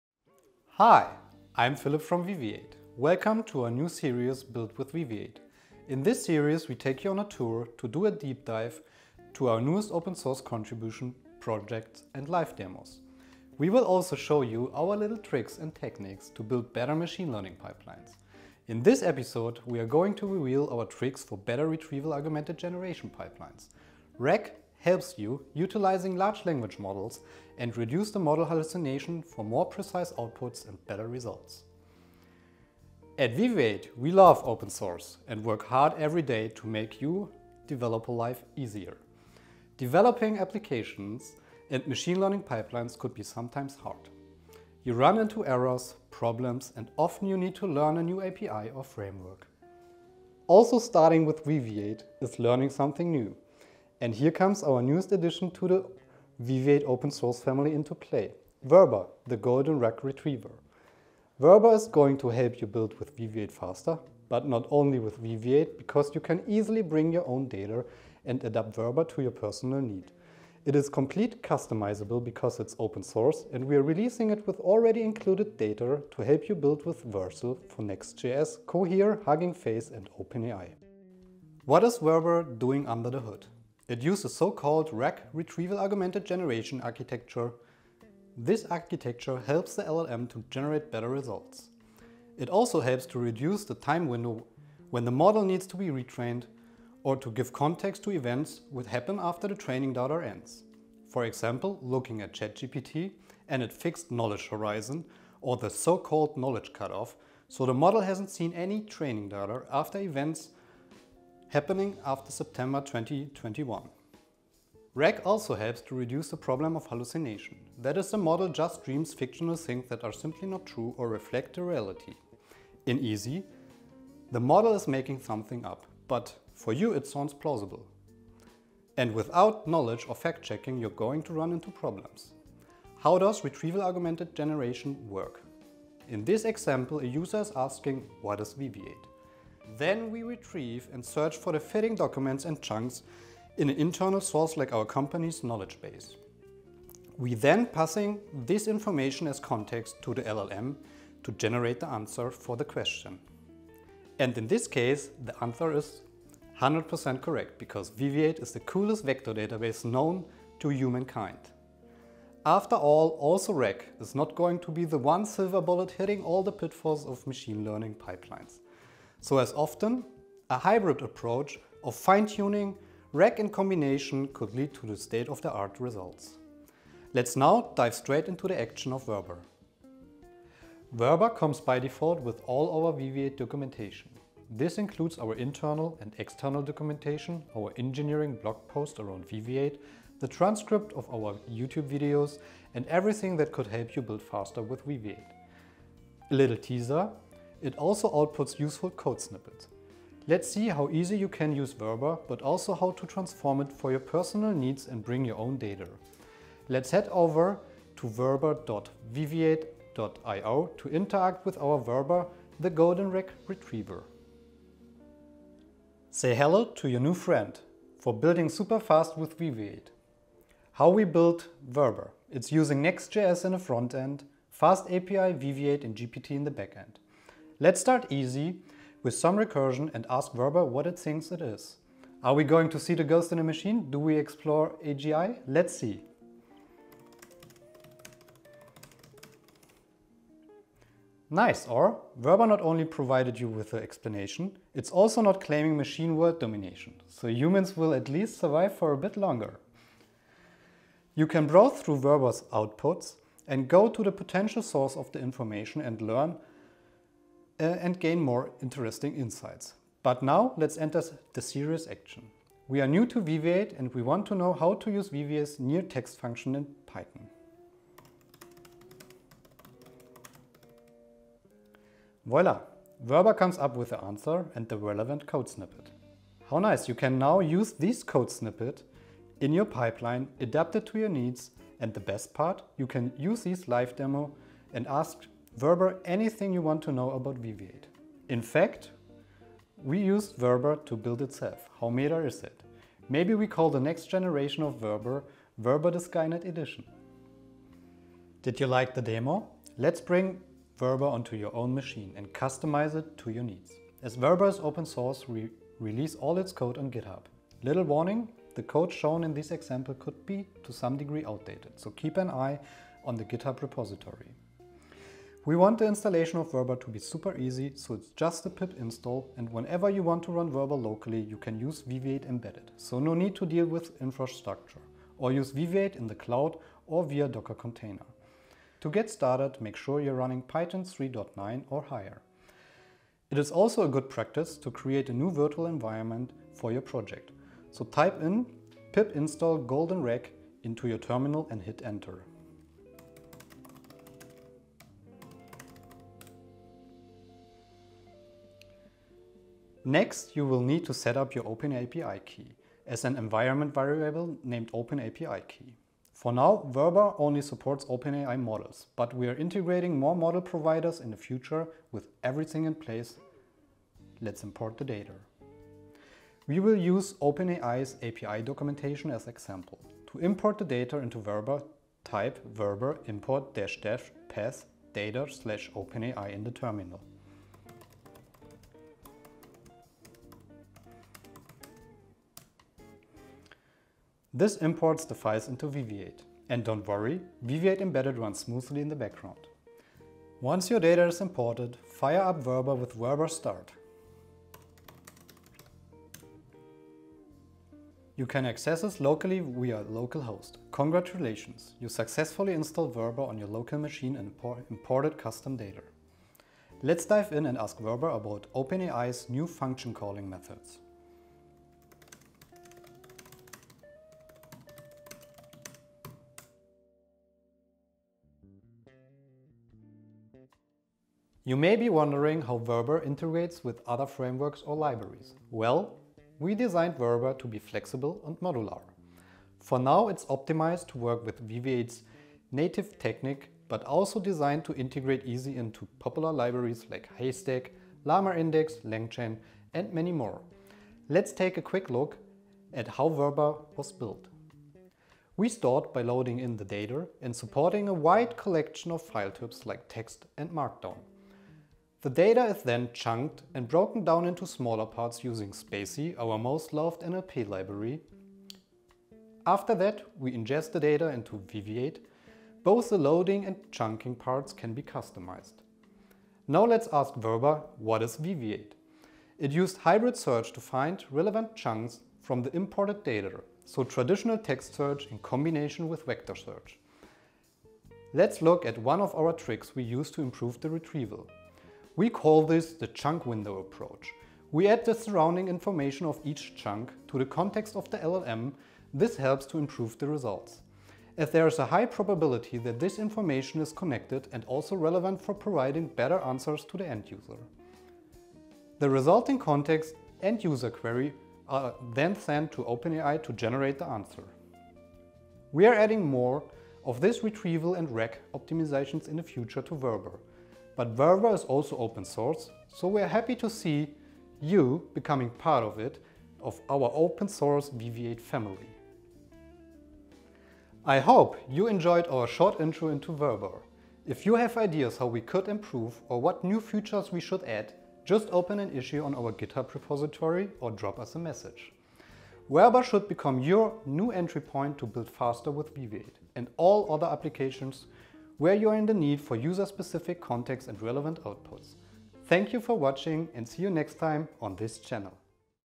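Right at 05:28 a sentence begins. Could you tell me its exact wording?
To get started, make sure you're running Python 3.9 or higher.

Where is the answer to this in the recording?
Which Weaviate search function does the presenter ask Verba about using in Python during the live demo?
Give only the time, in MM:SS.
04:25.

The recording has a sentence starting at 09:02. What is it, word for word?
Thank you for watching and see you next time on this channel.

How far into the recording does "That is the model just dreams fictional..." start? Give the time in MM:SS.
01:57.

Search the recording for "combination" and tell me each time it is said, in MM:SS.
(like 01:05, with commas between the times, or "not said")
02:53, 07:55.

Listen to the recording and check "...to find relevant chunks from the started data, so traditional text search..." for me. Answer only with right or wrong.
wrong.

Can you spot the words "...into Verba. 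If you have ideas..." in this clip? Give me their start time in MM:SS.
08:42.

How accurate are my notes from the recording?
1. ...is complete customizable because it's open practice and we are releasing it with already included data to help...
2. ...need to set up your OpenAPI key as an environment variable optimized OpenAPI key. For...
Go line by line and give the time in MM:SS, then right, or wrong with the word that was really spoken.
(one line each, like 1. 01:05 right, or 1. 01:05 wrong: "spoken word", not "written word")
1. 01:10 wrong: "source", not "practice"
2. 05:50 wrong: "named", not "optimized".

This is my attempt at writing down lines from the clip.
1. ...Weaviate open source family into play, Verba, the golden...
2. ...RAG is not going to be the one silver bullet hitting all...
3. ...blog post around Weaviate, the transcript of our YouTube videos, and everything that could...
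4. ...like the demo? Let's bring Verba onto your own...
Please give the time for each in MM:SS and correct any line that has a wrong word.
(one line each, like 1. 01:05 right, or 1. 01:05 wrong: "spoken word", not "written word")
1. 00:56 right
2. 02:43 right
3. 03:08 right
4. 04:58 right.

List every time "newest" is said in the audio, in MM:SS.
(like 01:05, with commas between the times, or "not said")
00:09, 00:54.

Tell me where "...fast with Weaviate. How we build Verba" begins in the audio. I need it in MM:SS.
03:38.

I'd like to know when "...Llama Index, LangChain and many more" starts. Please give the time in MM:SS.
07:18.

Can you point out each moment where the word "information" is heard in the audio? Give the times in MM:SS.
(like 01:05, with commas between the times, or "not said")
02:28, 04:15, 08:05, 08:12.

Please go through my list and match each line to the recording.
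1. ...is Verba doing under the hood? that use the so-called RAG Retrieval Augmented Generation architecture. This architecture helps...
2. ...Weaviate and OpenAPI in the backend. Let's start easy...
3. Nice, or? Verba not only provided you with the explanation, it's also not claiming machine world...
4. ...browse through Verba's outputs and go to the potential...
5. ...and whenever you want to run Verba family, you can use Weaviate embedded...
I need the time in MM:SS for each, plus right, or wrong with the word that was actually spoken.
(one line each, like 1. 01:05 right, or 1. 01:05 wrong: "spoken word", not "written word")
1. 01:21 right
2. 03:45 wrong: "GPT", not "OpenAPI"
3. 04:01 right
4. 04:11 right
5. 05:19 wrong: "locally", not "family".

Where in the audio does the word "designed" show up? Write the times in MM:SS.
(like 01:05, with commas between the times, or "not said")
07:06, 07:14.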